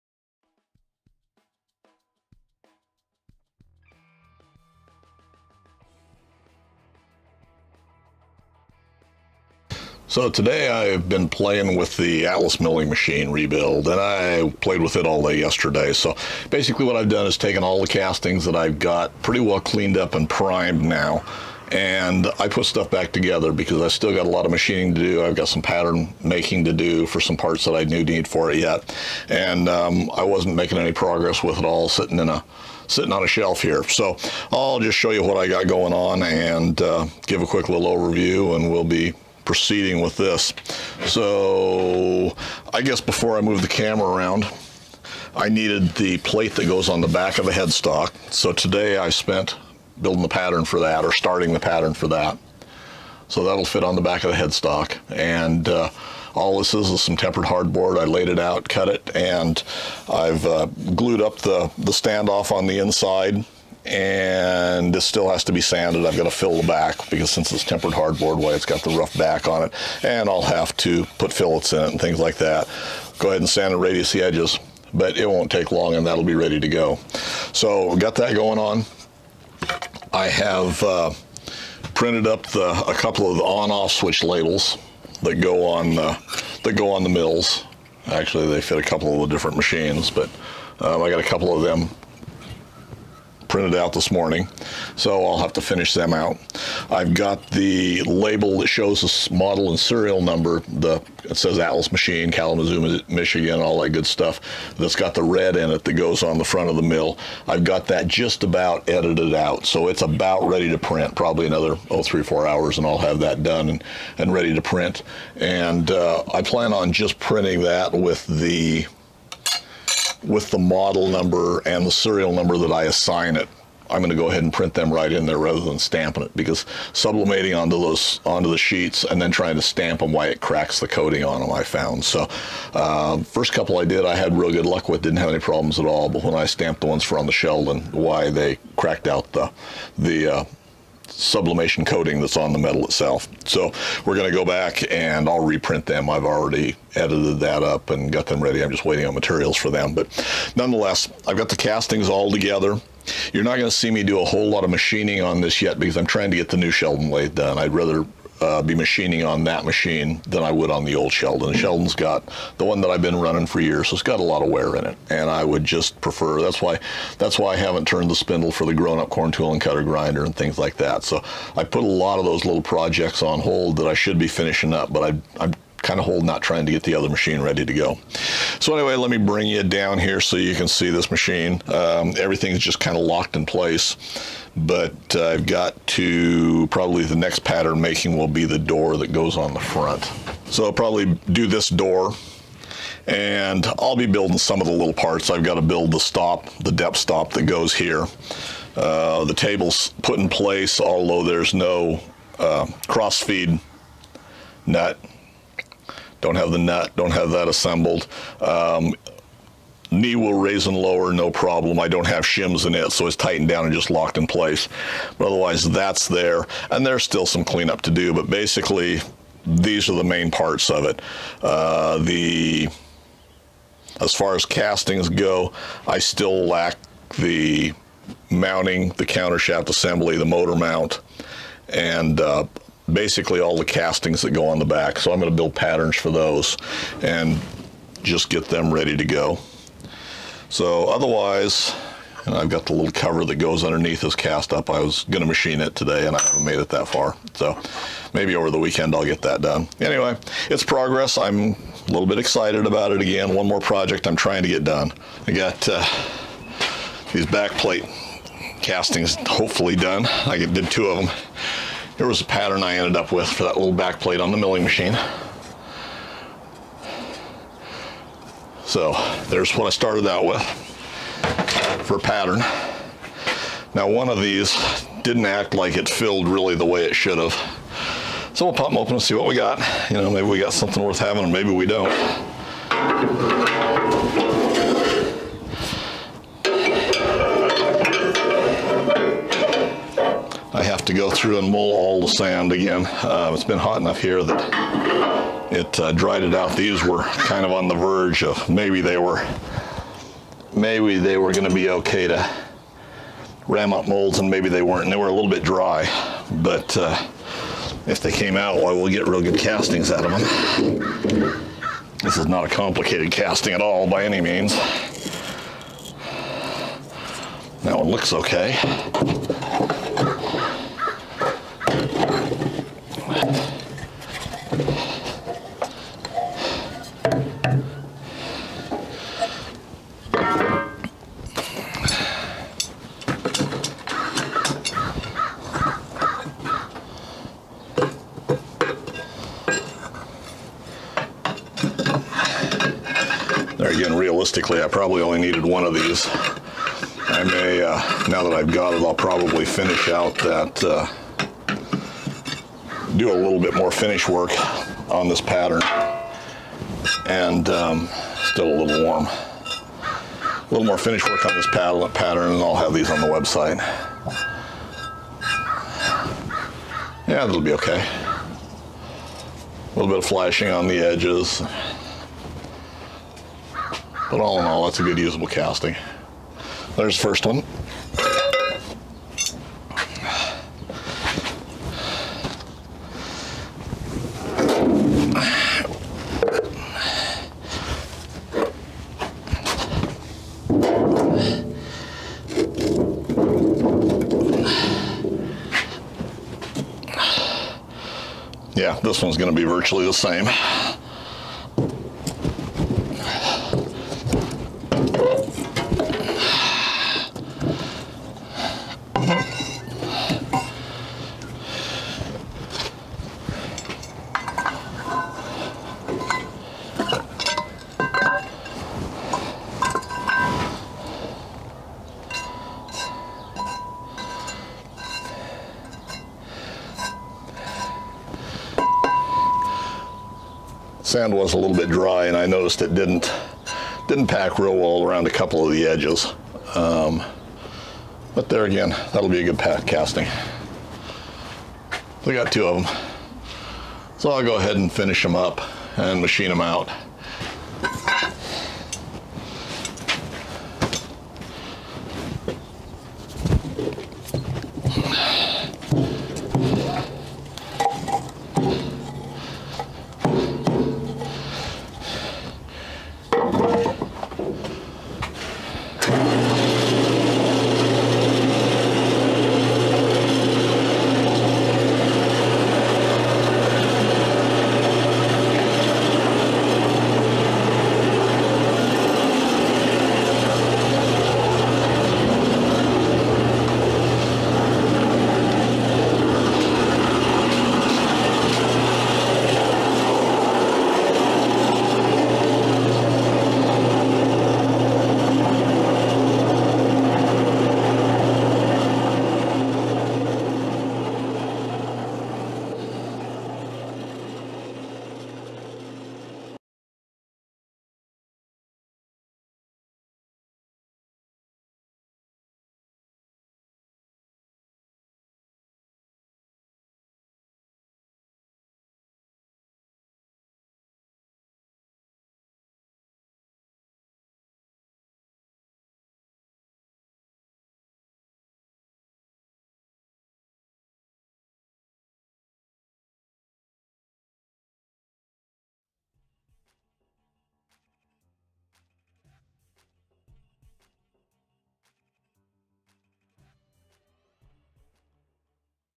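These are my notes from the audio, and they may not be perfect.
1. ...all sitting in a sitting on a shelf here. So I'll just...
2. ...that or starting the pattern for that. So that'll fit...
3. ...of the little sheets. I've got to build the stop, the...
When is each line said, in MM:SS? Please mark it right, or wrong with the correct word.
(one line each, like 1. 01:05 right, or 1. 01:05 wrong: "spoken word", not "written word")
1. 00:31 right
2. 00:50 right
3. 03:14 wrong: "parts", not "sheets".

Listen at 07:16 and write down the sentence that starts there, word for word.
Um, but there again, that'll be a good casting.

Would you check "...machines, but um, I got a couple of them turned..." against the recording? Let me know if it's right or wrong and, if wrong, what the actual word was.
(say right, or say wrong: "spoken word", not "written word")
wrong: "printed", not "turned".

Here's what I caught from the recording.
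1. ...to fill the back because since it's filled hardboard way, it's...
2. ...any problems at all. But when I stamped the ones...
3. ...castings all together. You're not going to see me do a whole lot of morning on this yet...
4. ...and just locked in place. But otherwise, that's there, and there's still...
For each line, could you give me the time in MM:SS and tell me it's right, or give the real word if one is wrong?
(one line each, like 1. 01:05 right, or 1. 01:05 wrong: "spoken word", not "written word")
1. 01:06 wrong: "tempered", not "filled"
2. 02:15 right
3. 02:31 wrong: "machining", not "morning"
4. 03:33 right.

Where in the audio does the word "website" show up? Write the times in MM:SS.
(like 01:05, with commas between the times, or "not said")
06:03.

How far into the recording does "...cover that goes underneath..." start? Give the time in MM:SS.
04:02.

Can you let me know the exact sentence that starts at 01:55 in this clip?
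And uh, I plan on just printing that with the with the model number and the serial number that I assign it.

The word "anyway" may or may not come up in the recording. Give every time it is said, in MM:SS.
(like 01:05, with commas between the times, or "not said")
02:58, 04:09.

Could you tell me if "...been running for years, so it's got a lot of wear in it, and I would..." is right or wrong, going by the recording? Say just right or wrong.
right.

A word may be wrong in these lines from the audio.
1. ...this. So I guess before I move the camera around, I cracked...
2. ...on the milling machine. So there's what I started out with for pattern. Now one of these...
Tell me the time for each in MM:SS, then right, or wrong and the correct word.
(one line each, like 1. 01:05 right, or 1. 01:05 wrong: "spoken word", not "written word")
1. 00:40 wrong: "needed", not "cracked"
2. 04:24 right.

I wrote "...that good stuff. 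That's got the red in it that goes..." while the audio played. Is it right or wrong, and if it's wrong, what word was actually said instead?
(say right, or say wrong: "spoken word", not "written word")
right.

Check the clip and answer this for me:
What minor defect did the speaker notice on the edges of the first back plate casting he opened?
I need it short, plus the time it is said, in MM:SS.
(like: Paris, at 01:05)
Flashing, at 06:10.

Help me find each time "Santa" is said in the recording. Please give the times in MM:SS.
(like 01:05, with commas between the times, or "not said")
not said.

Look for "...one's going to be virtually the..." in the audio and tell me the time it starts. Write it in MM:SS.
06:39.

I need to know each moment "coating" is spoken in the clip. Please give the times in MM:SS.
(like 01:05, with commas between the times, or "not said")
02:10, 02:21.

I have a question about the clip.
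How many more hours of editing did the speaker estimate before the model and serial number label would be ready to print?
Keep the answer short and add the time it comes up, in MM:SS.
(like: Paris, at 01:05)
3 to 4 hours, at 01:52.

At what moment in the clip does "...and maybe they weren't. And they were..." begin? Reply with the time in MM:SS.
05:04.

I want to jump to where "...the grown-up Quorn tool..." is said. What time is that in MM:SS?
02:48.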